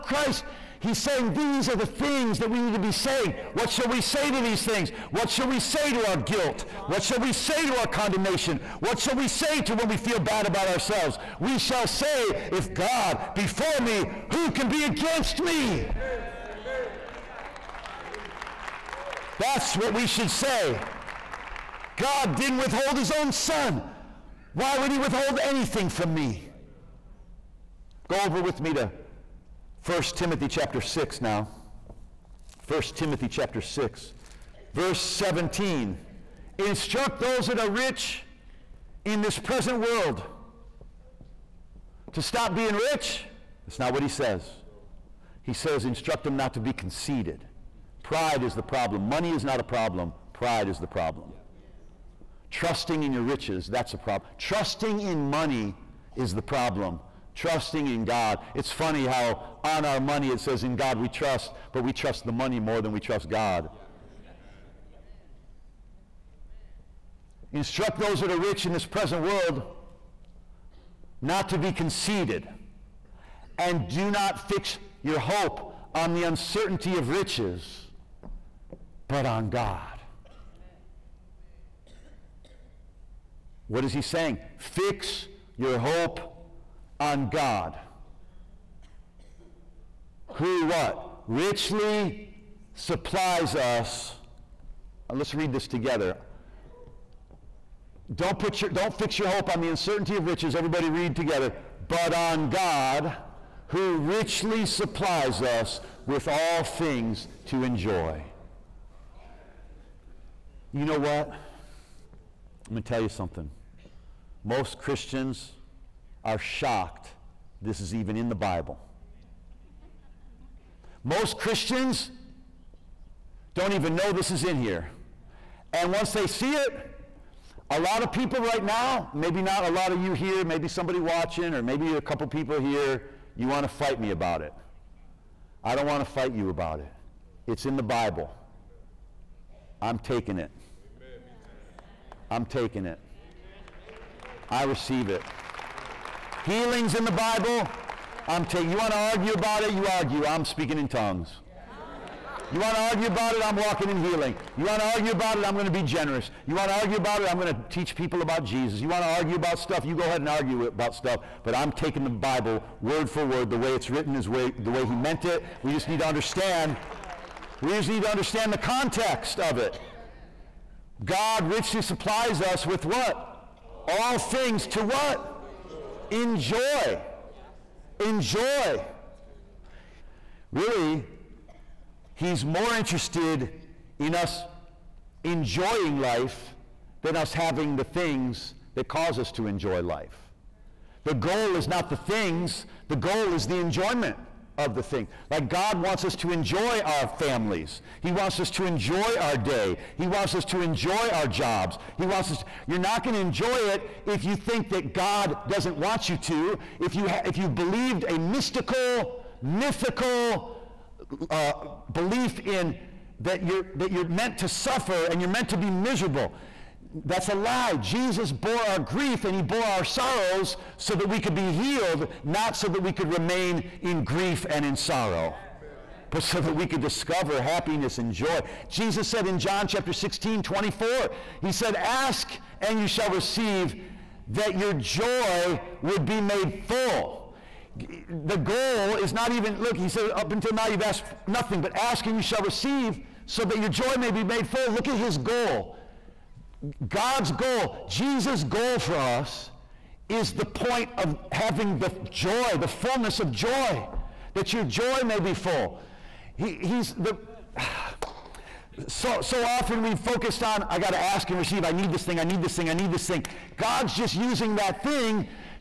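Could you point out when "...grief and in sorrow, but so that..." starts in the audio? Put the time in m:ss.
3:44.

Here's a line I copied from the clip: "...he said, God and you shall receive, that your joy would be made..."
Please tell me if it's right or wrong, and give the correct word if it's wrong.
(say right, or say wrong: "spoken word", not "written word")
wrong: "Ask", not "God".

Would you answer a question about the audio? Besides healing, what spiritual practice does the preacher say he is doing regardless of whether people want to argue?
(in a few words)
Speaking in tongues.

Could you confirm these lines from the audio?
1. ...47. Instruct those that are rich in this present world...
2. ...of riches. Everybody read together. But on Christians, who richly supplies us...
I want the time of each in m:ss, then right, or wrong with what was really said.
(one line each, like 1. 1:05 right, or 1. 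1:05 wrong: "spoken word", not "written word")
1. 0:34 wrong: "17", not "47"
2. 1:40 wrong: "God", not "Christians".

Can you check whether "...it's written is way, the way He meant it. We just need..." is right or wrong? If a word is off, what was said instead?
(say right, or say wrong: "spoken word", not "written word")
right.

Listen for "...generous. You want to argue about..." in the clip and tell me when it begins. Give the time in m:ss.
2:35.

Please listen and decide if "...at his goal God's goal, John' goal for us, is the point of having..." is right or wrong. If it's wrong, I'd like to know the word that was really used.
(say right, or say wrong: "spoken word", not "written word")
wrong: "Jesus", not "John".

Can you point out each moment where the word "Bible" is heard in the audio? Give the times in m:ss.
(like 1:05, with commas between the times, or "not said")
1:58, 2:17, 2:27, 2:42.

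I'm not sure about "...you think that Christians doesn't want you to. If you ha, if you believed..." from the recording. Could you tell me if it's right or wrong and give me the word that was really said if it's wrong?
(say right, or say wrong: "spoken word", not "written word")
wrong: "God", not "Christians".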